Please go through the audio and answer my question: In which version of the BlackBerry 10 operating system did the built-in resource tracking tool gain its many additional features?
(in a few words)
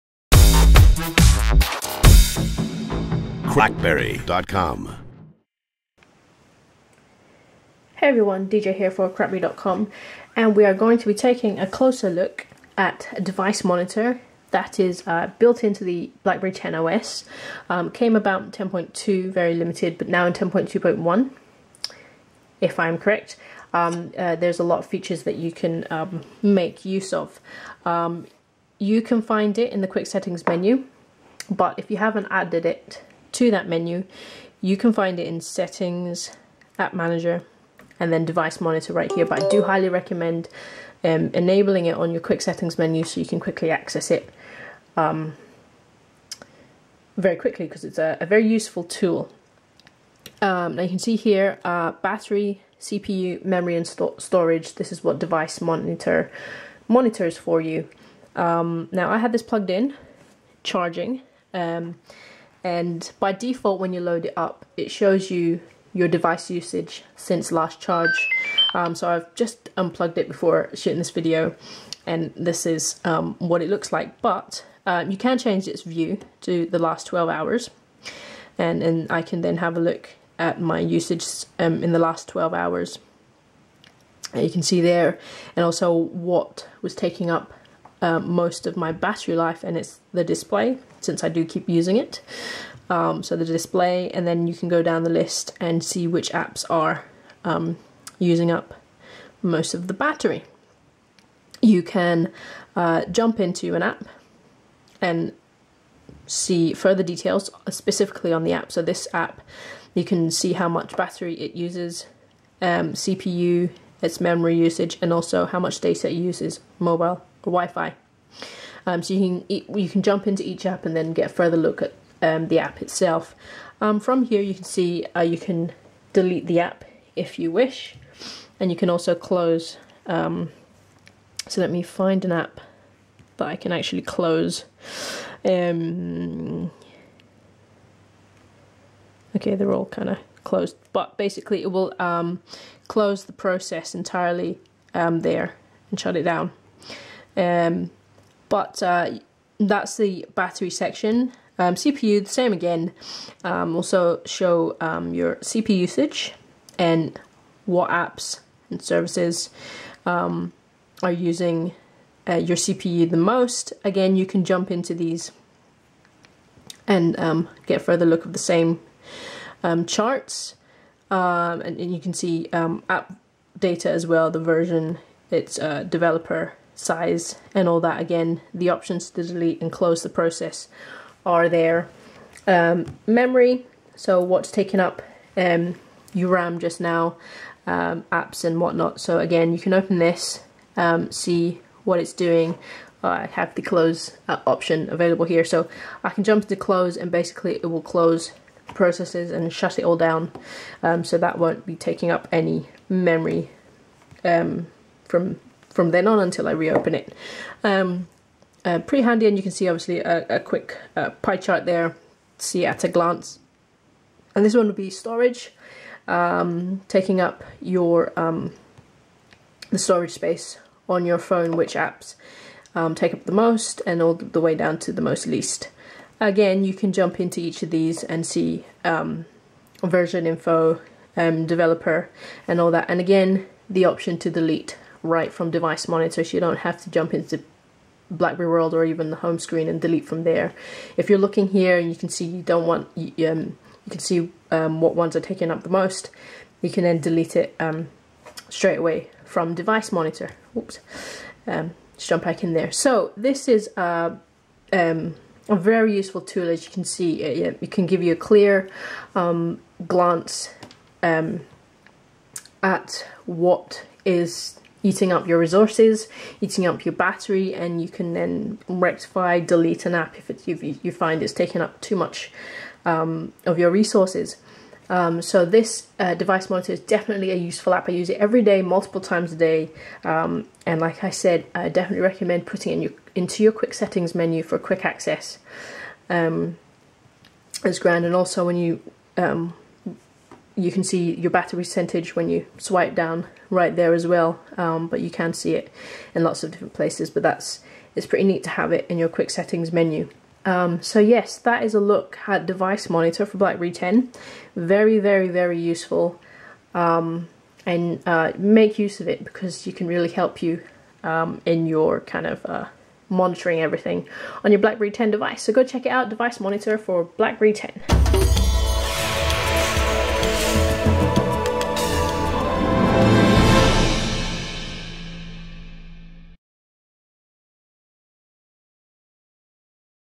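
10.2.1.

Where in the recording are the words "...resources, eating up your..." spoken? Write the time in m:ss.
4:25.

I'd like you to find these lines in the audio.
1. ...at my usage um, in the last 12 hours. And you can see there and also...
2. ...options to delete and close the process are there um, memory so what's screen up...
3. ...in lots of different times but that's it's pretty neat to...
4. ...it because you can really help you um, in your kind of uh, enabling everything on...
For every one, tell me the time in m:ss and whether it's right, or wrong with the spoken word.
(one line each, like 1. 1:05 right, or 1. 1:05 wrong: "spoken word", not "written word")
1. 1:20 right
2. 2:58 wrong: "taken", not "screen"
3. 4:56 wrong: "places", not "times"
4. 5:09 wrong: "monitoring", not "enabling".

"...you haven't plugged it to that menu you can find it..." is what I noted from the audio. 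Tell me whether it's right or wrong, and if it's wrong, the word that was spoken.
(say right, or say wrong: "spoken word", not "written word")
wrong: "added", not "plugged".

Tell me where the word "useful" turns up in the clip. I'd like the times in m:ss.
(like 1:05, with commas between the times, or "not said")
0:48, 4:15, 4:37, 5:05.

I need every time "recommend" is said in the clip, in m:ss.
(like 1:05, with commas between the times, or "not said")
0:39, 4:42.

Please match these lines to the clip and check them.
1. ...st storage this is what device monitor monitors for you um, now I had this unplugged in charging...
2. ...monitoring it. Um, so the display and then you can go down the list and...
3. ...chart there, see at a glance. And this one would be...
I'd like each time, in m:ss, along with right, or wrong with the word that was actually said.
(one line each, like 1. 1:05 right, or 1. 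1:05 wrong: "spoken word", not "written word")
1. 0:53 wrong: "plugged", not "unplugged"
2. 1:31 wrong: "using", not "monitoring"
3. 3:31 right.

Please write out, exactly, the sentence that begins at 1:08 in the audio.
Um, so I've just unplugged it before shooting this video and this is um, what it looks like.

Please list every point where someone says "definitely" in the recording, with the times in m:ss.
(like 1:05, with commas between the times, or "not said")
4:36, 4:41.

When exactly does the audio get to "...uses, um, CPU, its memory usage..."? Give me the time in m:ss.
1:51.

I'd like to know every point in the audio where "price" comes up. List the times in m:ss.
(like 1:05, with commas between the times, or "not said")
not said.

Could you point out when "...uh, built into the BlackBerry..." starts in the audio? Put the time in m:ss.
0:15.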